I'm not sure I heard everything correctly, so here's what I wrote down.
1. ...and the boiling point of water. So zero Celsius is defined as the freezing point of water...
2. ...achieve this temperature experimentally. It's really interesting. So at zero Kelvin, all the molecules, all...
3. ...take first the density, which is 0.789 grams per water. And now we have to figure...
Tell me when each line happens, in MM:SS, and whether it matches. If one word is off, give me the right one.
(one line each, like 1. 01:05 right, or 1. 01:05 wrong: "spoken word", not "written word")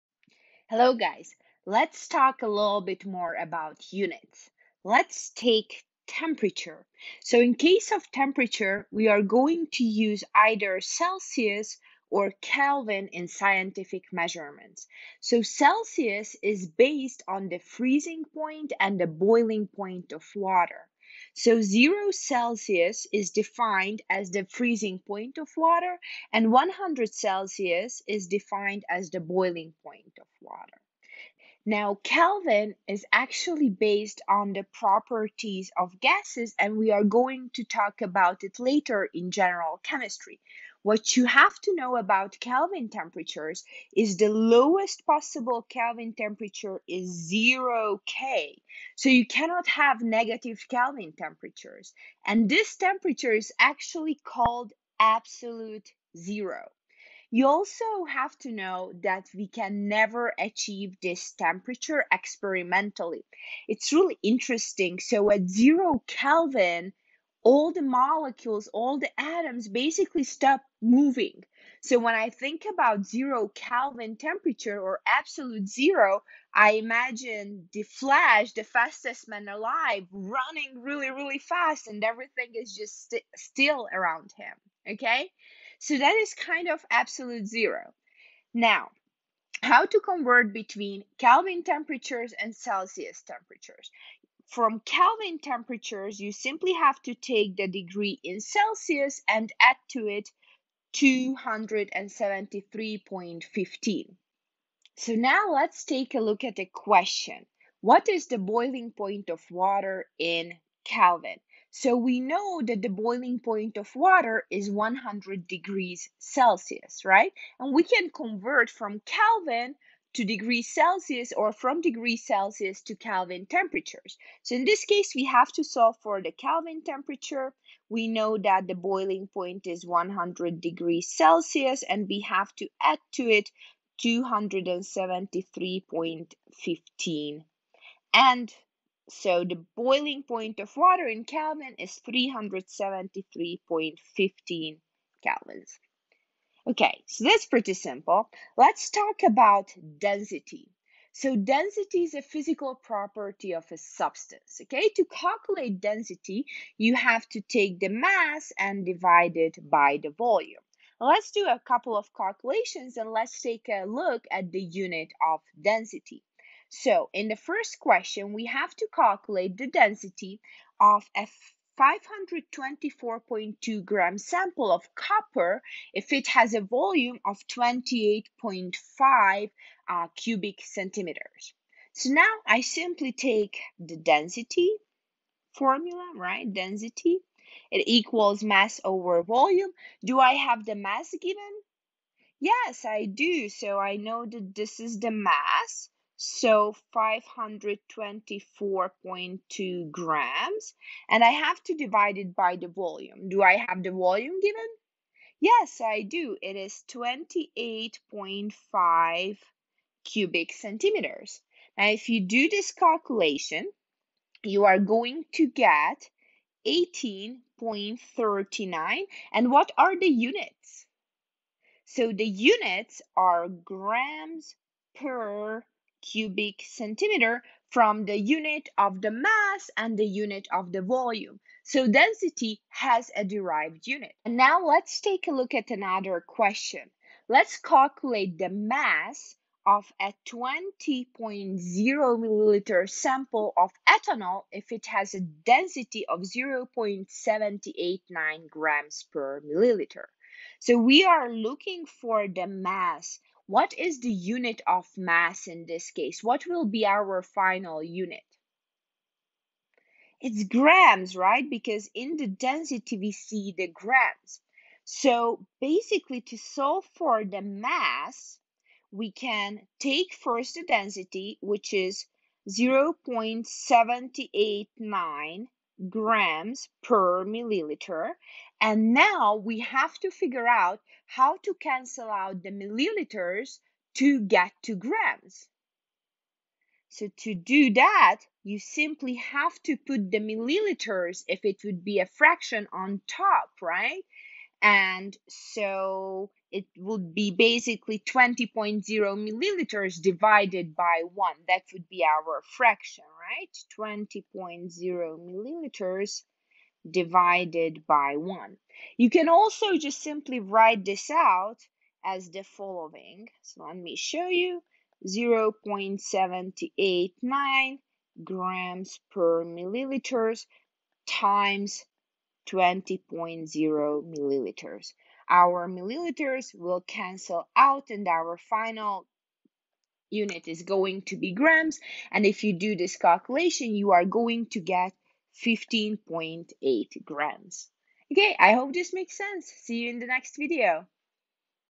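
1. 00:18 right
2. 01:00 right
3. 04:29 wrong: "milliliter", not "water".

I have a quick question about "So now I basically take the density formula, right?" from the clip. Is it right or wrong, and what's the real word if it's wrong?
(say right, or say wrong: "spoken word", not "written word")
wrong: "simply", not "basically".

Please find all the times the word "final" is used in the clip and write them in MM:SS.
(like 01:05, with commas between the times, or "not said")
04:17, 05:28.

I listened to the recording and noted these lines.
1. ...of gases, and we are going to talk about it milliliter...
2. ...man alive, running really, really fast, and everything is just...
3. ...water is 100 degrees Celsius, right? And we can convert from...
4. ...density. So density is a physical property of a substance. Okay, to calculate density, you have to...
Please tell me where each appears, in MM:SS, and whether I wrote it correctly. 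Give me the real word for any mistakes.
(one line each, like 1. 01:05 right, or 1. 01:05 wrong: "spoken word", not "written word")
1. 00:35 wrong: "later", not "milliliter"
2. 01:19 right
3. 01:53 right
4. 02:29 right.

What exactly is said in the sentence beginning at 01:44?
So now let's take a look at the question.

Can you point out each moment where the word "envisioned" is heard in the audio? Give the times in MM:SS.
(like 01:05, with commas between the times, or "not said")
not said.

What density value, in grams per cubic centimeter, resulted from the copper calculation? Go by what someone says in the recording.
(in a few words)
18.39.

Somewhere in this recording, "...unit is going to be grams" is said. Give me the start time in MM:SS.
05:30.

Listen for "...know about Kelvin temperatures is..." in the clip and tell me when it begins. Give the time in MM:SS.
00:41.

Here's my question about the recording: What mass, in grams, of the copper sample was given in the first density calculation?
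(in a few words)
524.2 grams.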